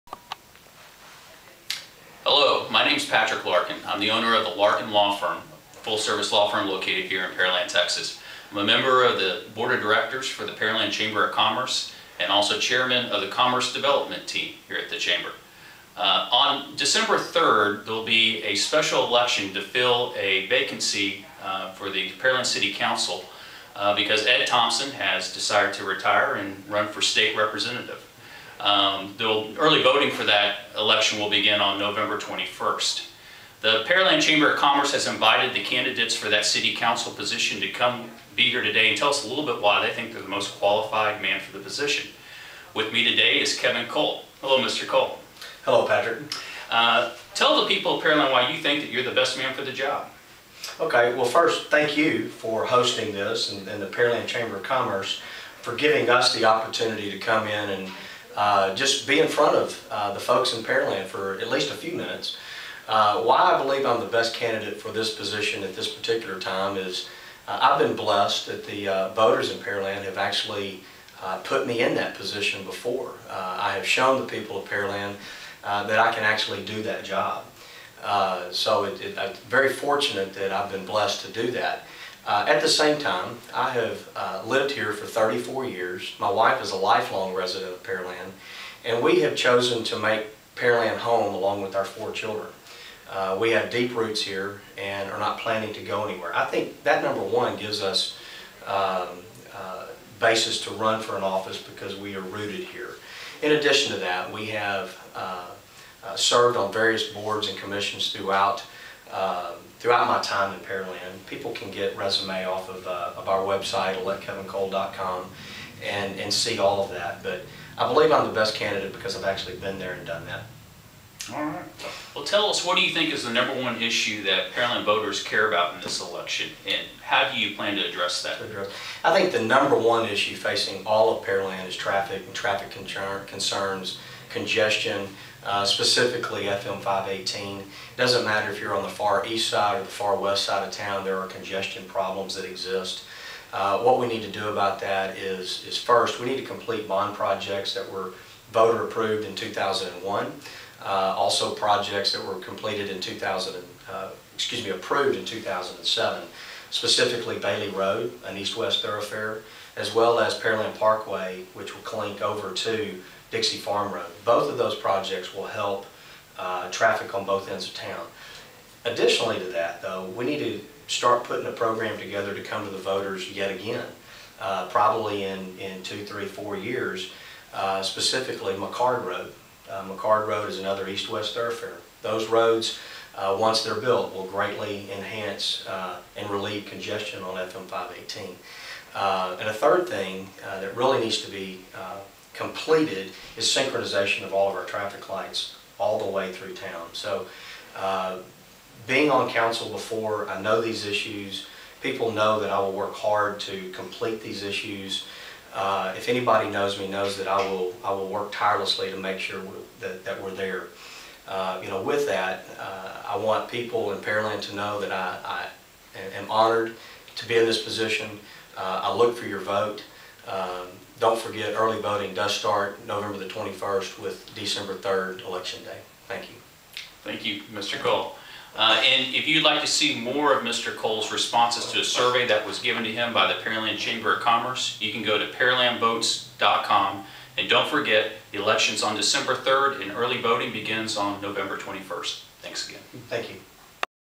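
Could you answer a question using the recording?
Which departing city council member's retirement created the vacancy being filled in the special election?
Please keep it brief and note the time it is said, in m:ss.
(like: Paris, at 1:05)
Ed Thompson, at 0:24.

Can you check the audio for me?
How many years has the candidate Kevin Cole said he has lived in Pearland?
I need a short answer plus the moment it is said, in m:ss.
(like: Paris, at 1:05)
34, at 1:25.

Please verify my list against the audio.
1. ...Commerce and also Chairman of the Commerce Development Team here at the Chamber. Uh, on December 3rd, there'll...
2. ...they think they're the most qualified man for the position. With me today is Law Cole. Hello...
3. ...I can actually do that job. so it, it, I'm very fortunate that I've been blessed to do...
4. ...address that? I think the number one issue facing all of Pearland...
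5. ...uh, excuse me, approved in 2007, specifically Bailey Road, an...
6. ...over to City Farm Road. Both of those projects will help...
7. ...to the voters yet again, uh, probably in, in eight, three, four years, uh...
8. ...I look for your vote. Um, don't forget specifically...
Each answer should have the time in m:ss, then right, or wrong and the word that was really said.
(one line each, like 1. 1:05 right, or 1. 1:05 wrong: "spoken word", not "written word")
1. 0:11 right
2. 0:39 wrong: "Kevin", not "Law"
3. 1:15 right
4. 2:07 right
5. 2:33 right
6. 2:42 wrong: "Dixie", not "City"
7. 2:52 wrong: "two", not "eight"
8. 3:38 wrong: "early", not "specifically".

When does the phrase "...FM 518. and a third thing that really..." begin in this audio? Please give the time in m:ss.
3:07.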